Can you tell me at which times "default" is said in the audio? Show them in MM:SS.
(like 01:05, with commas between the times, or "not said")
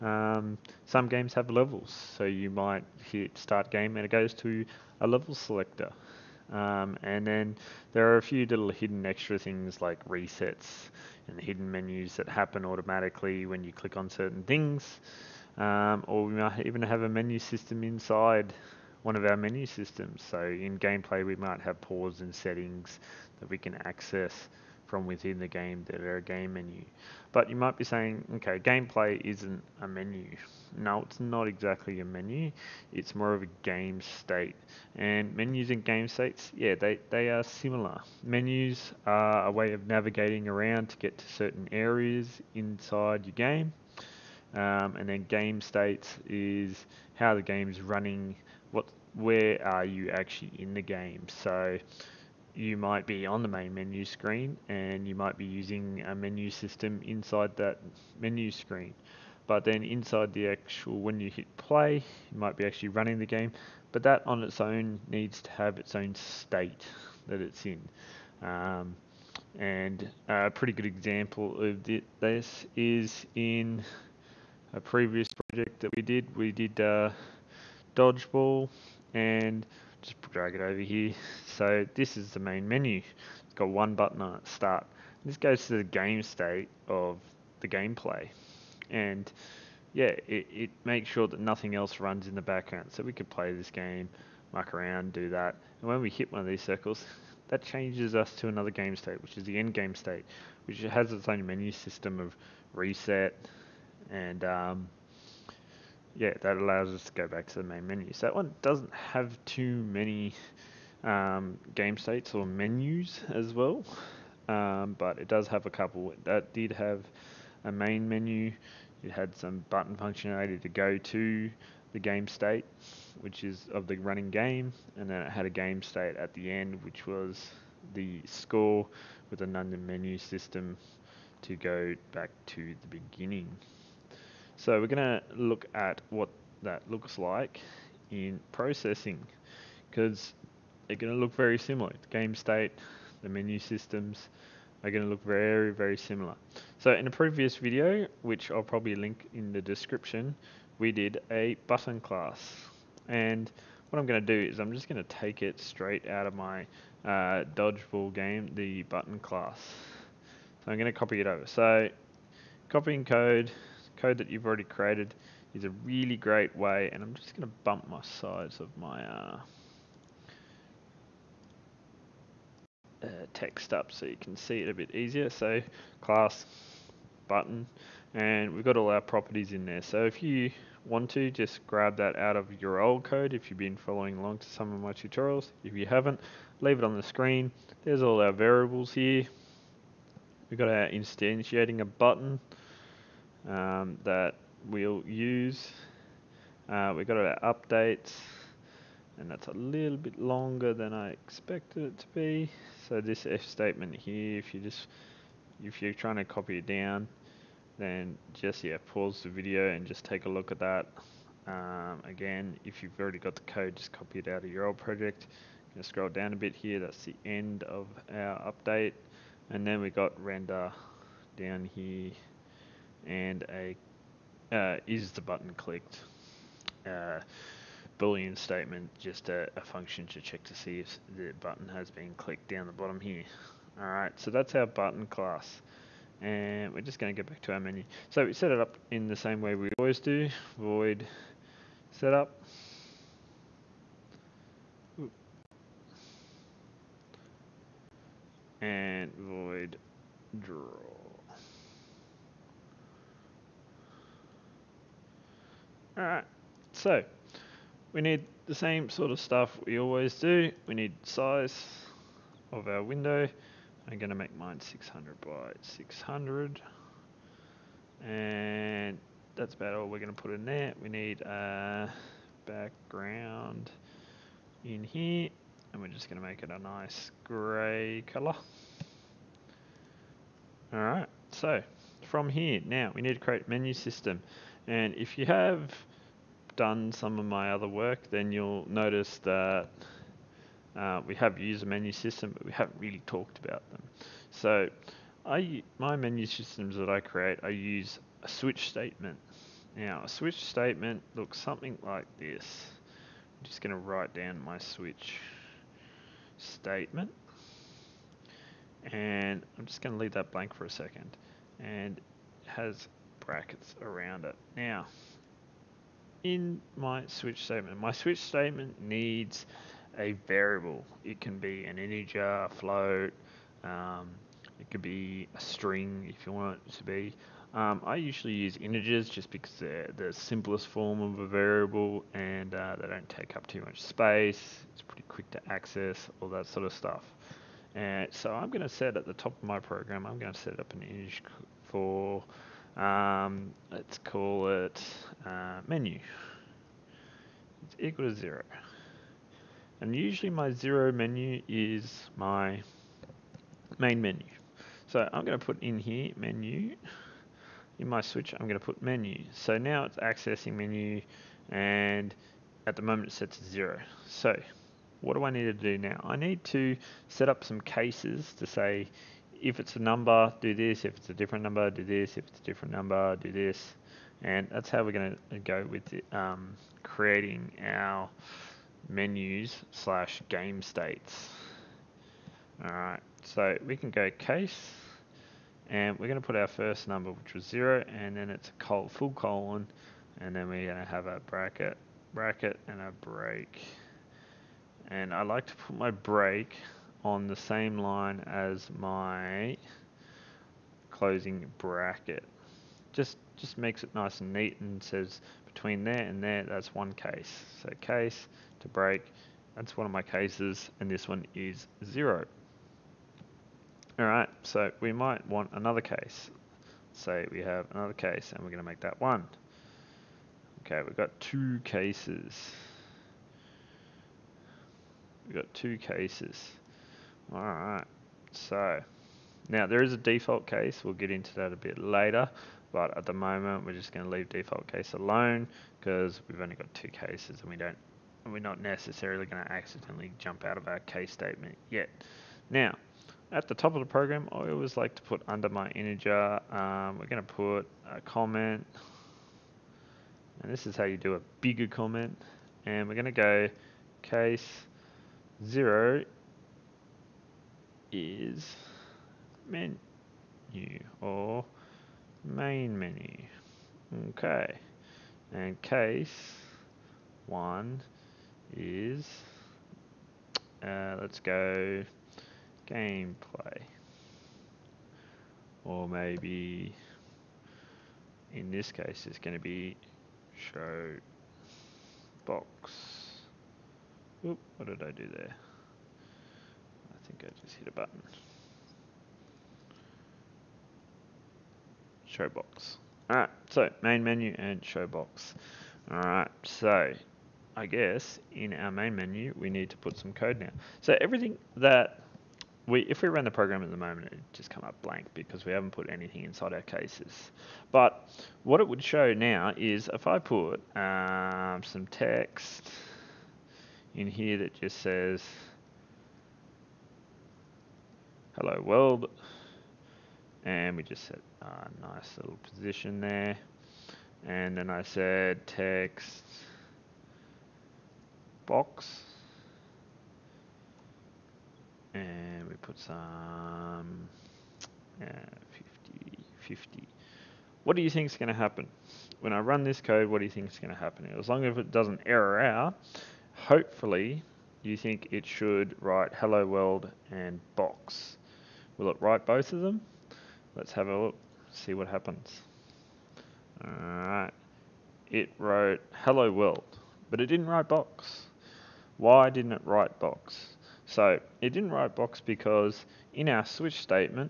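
07:09, 07:14.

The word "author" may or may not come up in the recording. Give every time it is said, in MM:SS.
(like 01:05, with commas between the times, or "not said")
not said.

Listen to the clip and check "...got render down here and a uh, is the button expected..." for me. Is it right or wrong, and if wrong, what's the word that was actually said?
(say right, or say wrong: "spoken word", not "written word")
wrong: "clicked", not "expected".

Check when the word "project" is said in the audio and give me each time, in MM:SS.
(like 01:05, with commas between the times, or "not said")
01:15, 03:34.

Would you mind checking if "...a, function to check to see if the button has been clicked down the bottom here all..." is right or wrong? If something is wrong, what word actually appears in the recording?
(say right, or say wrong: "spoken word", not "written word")
right.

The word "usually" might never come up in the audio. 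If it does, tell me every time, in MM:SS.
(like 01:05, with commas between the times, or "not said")
05:27, 05:49.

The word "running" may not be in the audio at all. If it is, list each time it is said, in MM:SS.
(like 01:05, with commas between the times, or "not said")
00:47, 01:02, 02:03.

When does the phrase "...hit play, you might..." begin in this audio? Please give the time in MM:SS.
01:01.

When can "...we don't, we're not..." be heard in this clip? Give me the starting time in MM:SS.
07:17.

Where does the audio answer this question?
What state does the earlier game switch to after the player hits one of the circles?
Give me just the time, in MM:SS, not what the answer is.
01:39.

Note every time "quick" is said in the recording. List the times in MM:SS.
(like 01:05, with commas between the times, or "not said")
05:35.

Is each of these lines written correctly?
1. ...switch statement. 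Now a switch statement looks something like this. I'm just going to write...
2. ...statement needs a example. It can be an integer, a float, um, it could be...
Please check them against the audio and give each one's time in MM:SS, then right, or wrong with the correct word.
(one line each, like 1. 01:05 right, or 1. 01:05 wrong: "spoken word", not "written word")
1. 04:58 right
2. 05:18 wrong: "variable", not "example".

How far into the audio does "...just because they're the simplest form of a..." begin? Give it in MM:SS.
05:29.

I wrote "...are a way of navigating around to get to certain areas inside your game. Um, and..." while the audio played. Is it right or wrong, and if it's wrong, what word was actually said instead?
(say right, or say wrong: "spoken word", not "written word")
right.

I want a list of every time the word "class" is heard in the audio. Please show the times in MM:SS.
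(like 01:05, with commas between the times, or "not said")
02:32, 02:39, 02:56, 03:55.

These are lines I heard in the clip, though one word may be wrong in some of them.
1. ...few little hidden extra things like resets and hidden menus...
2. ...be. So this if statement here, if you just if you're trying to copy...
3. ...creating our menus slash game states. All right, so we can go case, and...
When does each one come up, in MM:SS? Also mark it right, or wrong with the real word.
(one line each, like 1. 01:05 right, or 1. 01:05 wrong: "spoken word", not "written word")
1. 00:08 right
2. 03:22 right
3. 06:16 right.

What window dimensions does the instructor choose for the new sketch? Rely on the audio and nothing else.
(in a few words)
600 by 600.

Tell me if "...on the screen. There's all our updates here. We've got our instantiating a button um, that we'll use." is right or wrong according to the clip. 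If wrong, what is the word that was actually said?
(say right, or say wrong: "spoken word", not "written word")
wrong: "variables", not "updates".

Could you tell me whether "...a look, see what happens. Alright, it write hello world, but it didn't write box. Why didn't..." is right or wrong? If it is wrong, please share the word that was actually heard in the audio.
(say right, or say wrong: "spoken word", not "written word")
wrong: "wrote", not "write".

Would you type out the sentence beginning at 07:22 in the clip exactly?
Now, at the top of the program, I always like to put under my integer, um, we're going to put a comment.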